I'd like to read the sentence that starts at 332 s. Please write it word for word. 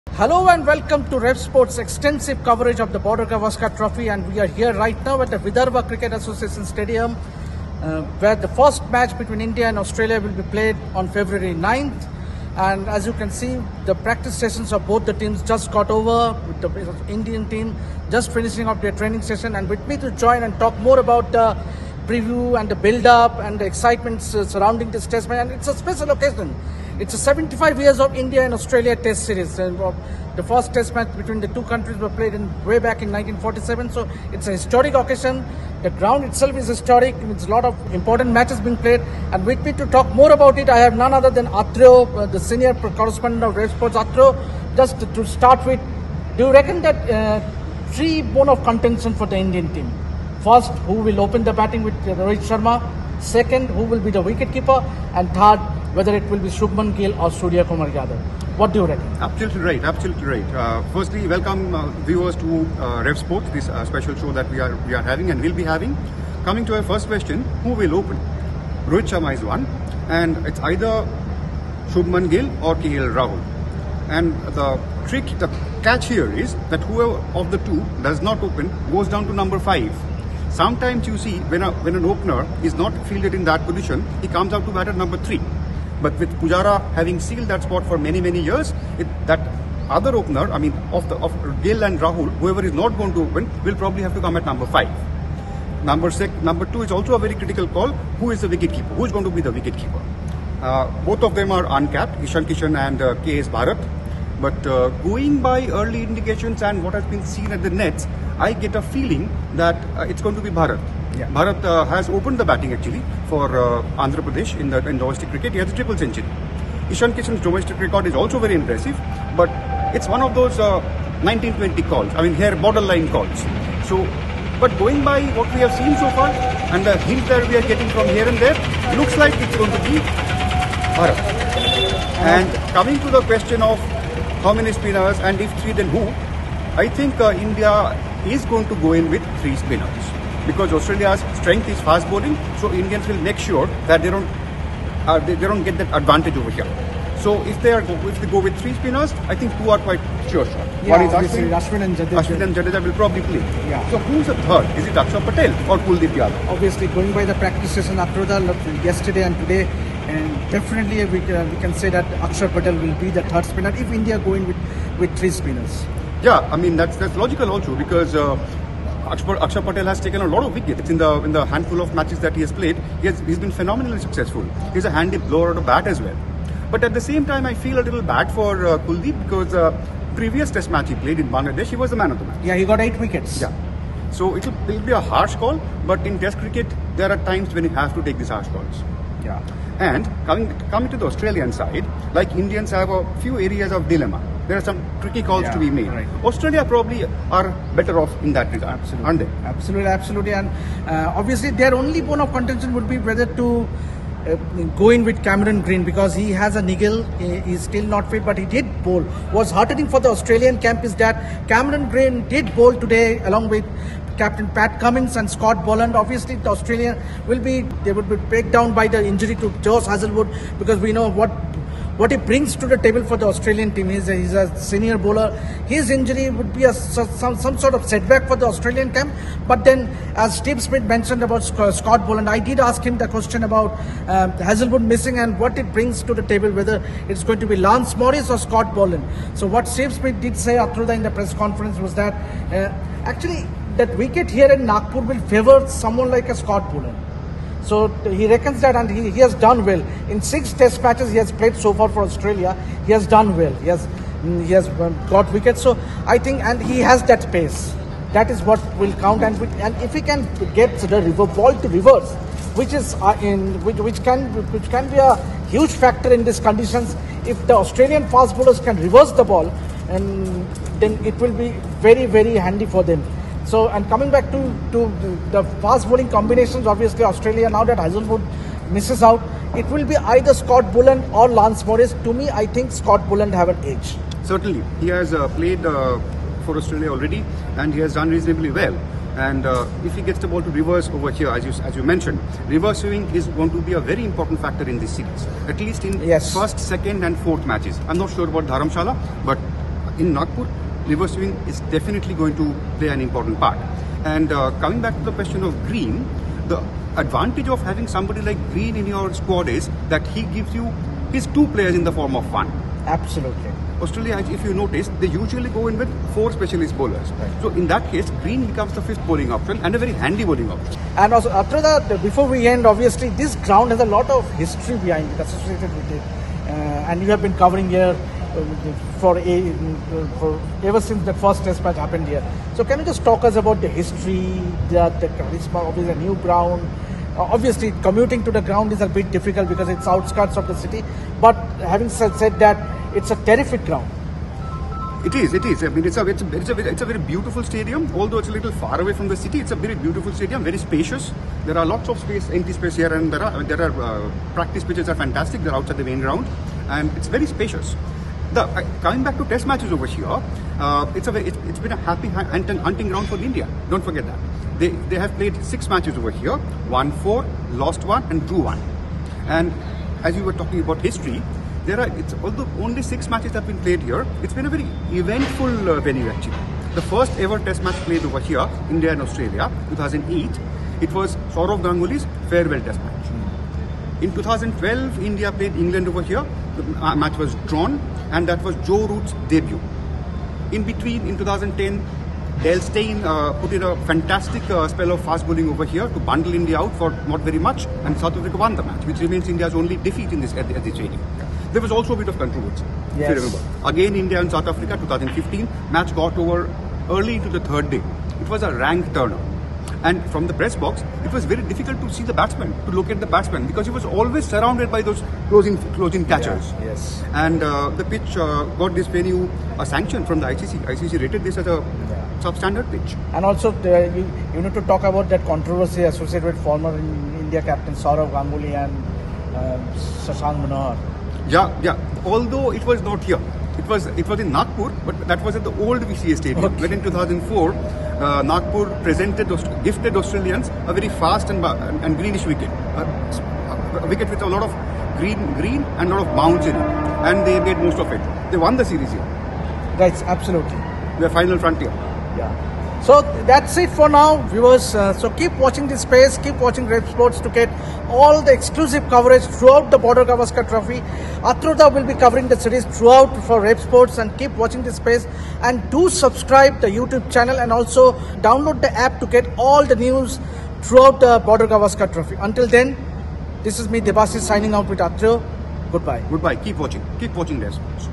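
So can you just talk us about the history, the, the charisma, obviously a new ground.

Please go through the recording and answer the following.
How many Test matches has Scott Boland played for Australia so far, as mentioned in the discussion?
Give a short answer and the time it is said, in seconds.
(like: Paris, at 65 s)
6, at 250 s.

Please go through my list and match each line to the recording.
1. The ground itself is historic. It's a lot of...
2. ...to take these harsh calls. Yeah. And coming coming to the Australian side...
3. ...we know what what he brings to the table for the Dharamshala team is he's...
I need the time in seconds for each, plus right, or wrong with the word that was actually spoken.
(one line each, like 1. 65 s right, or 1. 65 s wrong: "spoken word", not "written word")
1. 35 s right
2. 187 s right
3. 220 s wrong: "Australian", not "Dharamshala".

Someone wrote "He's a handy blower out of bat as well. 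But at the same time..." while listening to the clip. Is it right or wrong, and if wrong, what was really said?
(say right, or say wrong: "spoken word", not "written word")
right.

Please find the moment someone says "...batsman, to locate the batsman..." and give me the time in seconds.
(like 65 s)
412 s.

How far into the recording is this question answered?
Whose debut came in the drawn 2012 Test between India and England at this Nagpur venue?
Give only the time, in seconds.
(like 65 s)
388 s.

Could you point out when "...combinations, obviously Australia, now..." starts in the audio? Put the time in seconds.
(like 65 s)
276 s.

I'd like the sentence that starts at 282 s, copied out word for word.
To me, I think Scott Boland have an edge.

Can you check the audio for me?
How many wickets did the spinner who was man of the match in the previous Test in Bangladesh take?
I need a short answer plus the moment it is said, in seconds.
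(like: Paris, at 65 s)
8, at 182 s.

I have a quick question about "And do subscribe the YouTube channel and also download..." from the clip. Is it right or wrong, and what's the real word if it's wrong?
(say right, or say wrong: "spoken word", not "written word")
right.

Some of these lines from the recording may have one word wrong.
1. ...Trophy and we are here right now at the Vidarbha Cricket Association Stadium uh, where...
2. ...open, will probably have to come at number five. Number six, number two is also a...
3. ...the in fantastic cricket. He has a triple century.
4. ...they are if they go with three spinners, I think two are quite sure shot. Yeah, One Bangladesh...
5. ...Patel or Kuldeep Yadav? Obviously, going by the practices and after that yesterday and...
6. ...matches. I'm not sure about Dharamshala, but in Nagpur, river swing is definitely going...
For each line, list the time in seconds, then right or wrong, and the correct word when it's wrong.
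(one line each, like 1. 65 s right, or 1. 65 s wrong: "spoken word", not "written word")
1. 3 s right
2. 93 s right
3. 114 s wrong: "domestic", not "fantastic"
4. 147 s wrong: "Ashwin", not "Bangladesh"
5. 155 s right
6. 297 s right.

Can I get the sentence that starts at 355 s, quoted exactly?
They're outside the main ground, and it's very spacious.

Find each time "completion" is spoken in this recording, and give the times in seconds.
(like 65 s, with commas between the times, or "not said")
not said.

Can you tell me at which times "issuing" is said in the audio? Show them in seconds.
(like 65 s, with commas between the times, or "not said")
not said.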